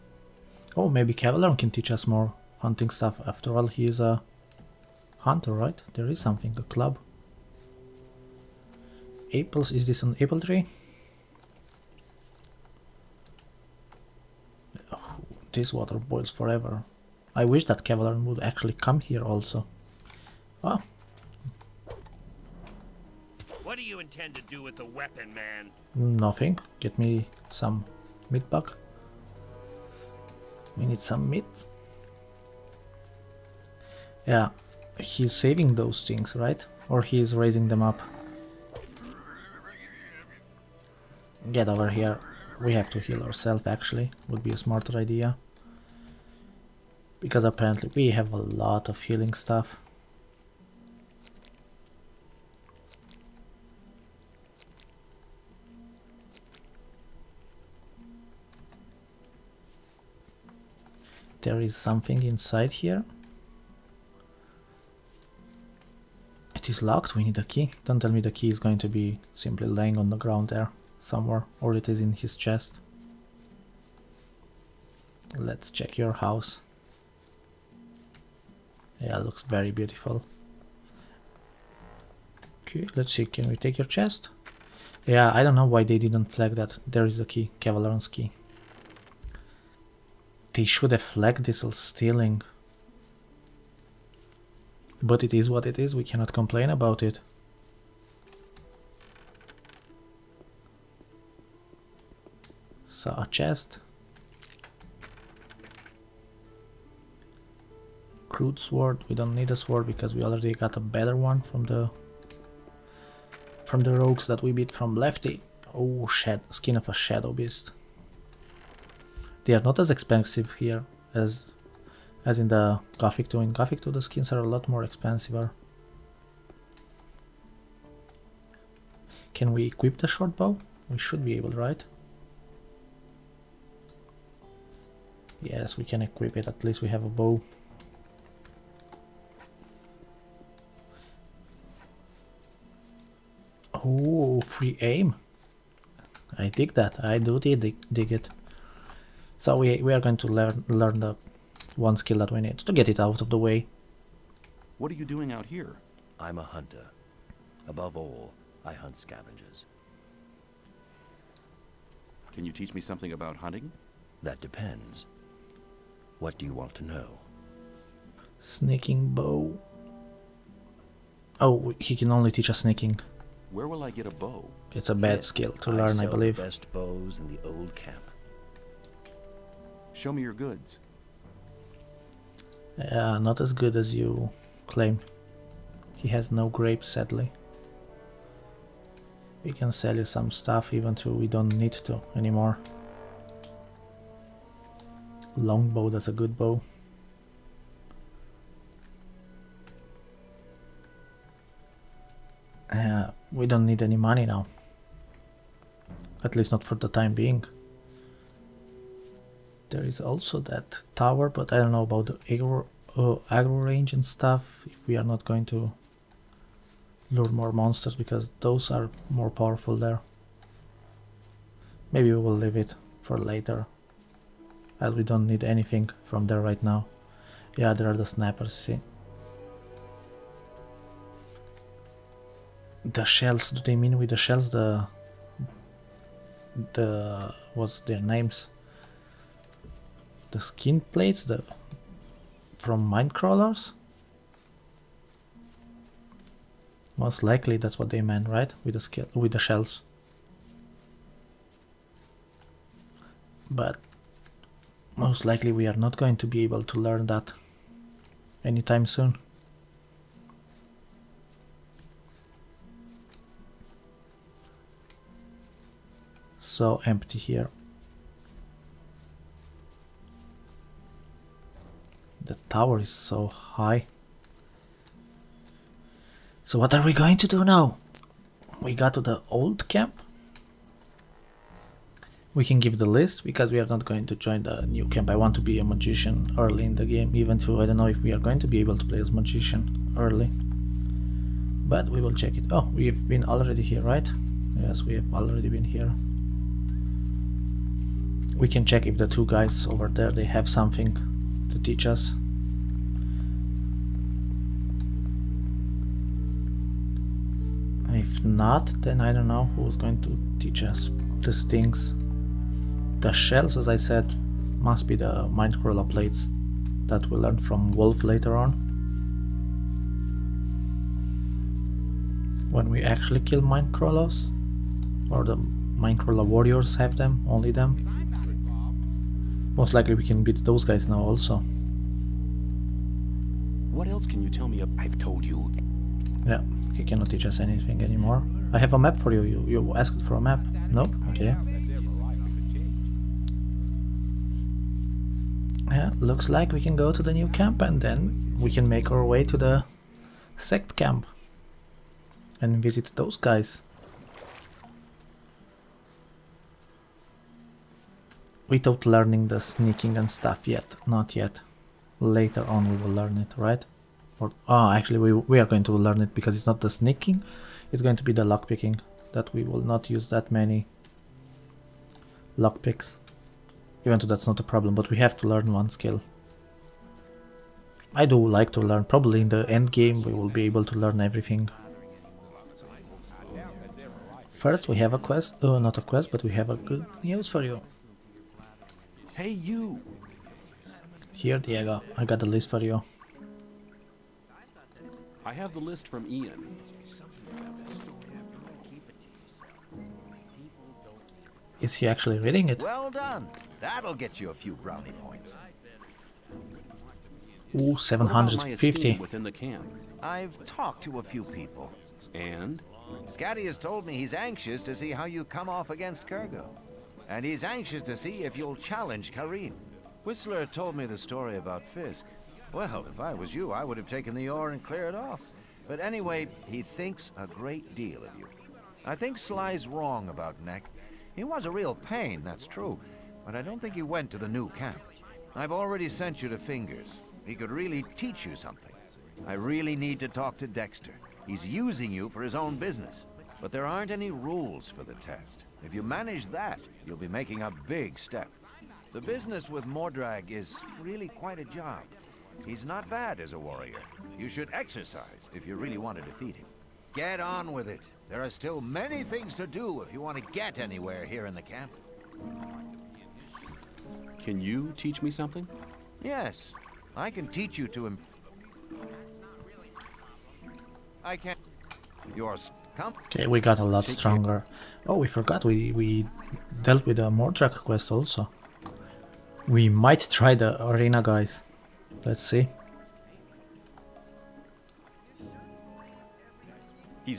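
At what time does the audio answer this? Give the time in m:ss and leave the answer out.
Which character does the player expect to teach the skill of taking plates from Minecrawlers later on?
5:17.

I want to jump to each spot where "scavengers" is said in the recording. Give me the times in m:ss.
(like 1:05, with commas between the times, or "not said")
2:38.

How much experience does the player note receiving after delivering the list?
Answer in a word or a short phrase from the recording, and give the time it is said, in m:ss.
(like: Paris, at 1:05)
750, at 6:47.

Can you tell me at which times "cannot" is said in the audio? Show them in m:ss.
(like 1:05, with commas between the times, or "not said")
1:36, 5:36.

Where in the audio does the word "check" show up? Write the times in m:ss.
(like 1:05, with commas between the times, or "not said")
1:15, 4:52, 4:58.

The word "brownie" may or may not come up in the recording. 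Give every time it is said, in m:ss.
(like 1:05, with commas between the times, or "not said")
6:44.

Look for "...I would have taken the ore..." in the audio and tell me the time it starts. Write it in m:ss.
7:03.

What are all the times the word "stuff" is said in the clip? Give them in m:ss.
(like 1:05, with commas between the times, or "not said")
0:02, 0:49, 3:10, 3:34, 6:00.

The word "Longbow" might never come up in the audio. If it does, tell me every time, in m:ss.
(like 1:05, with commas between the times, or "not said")
3:15.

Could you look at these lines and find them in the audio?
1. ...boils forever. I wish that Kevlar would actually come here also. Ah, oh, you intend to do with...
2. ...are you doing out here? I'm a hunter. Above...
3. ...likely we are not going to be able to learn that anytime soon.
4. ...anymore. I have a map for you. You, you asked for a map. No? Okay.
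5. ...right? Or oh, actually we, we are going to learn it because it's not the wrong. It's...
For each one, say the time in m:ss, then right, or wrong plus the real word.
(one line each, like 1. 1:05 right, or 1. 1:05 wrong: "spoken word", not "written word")
1. 0:15 right
2. 2:34 right
3. 4:15 right
4. 5:37 right
5. 6:03 wrong: "sneaking", not "wrong".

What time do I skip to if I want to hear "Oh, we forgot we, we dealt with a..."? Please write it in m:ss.
7:54.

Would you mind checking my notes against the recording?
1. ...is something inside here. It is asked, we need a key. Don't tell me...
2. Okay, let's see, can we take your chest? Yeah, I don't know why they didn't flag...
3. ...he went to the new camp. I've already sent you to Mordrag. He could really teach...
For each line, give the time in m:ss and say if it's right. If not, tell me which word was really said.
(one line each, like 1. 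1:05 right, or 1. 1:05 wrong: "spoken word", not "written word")
1. 1:01 wrong: "locked", not "asked"
2. 1:22 right
3. 7:13 wrong: "Fingers", not "Mordrag".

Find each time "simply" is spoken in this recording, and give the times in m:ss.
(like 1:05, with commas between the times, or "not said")
1:09.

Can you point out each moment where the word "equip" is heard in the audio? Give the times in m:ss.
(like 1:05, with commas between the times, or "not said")
2:09, 2:16.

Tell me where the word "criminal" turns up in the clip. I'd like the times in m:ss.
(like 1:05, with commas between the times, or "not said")
not said.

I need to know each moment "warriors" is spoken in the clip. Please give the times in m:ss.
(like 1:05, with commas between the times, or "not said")
5:26, 7:33.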